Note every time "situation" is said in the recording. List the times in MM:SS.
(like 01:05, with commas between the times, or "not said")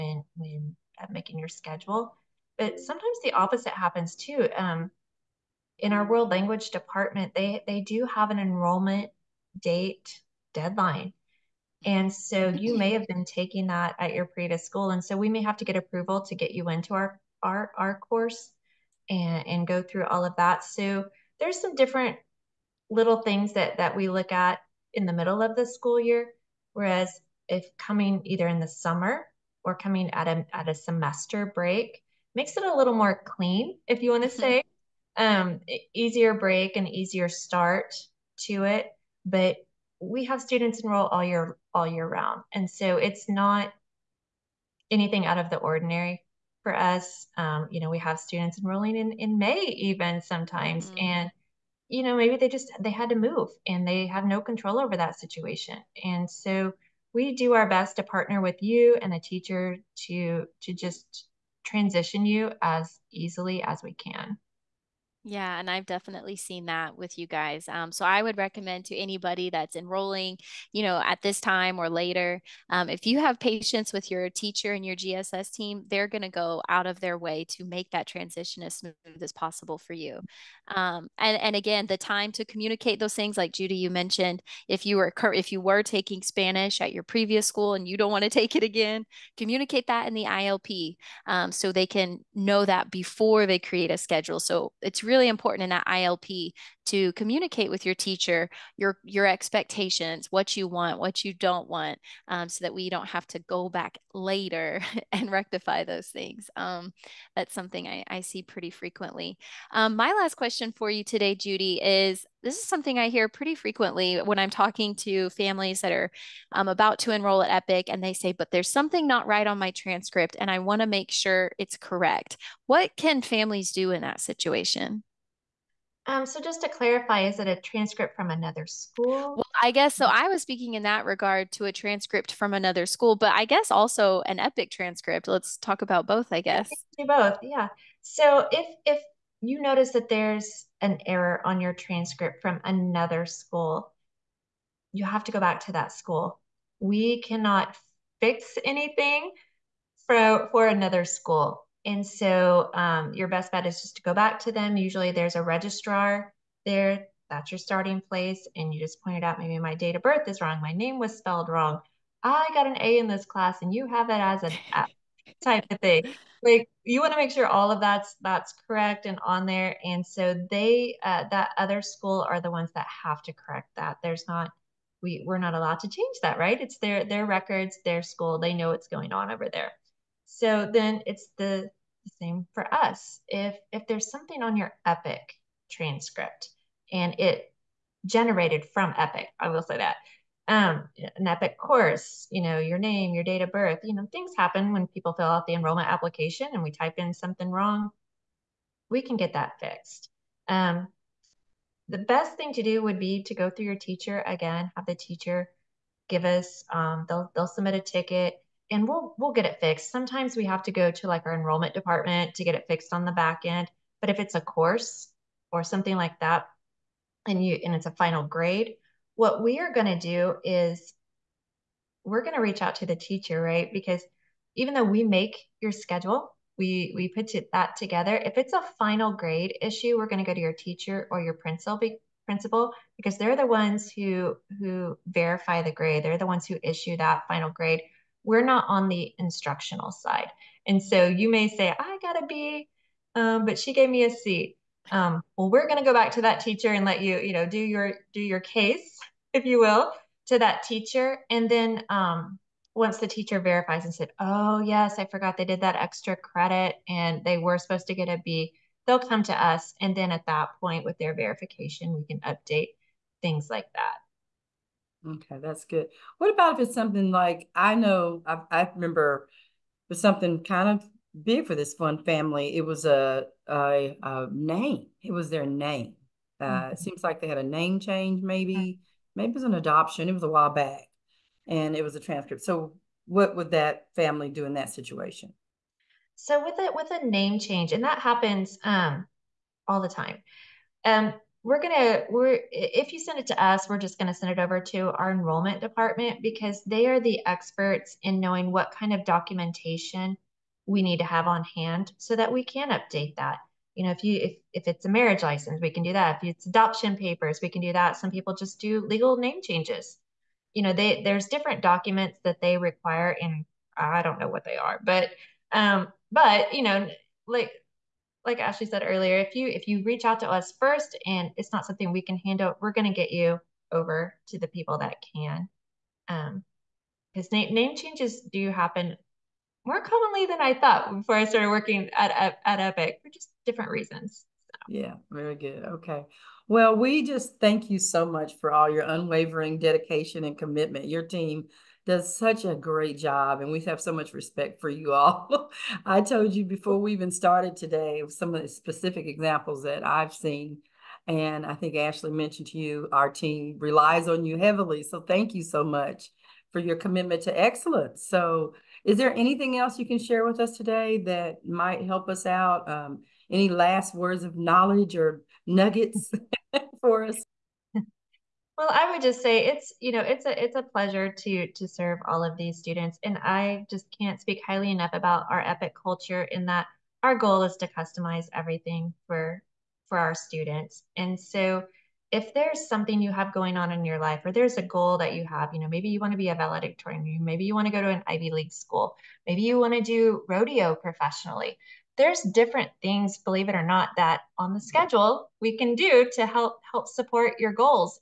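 00:55, 02:04, 04:44.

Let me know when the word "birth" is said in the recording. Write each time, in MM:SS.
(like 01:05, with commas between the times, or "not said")
02:40, 03:13.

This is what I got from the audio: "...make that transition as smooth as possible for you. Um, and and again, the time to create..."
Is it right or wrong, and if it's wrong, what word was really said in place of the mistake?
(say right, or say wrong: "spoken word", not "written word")
wrong: "communicate", not "create".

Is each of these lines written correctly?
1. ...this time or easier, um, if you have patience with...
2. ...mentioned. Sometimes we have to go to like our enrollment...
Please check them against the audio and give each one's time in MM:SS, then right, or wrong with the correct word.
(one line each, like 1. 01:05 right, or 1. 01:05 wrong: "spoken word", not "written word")
1. 01:11 wrong: "later", not "easier"
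2. 03:29 wrong: "fixed", not "mentioned".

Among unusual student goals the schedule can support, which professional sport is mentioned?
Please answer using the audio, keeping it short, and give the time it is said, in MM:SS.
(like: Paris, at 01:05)
Rodeo, at 06:30.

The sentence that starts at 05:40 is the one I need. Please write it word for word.
Your team does such a great job, and we have so much respect for you all.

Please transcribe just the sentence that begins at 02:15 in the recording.
Let's talk about both, I guess.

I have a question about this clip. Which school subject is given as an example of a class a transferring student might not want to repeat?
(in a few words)
Spanish.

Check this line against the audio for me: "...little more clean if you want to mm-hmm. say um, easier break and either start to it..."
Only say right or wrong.
wrong.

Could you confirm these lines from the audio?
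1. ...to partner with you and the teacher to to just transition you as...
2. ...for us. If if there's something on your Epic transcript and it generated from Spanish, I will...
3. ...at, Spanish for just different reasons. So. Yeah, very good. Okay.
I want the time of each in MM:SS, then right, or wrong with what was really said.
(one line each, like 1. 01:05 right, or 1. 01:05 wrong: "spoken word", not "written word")
1. 00:57 right
2. 03:02 wrong: "Epic", not "Spanish"
3. 05:32 wrong: "Epic", not "Spanish".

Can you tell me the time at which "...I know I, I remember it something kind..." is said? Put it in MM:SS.
04:27.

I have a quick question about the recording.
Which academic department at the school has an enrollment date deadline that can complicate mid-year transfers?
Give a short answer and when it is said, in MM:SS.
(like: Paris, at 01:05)
World language department, at 00:06.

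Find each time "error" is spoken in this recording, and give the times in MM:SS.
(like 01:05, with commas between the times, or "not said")
02:21.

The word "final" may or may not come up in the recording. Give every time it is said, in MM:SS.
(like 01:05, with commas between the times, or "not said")
03:37, 03:48, 03:57.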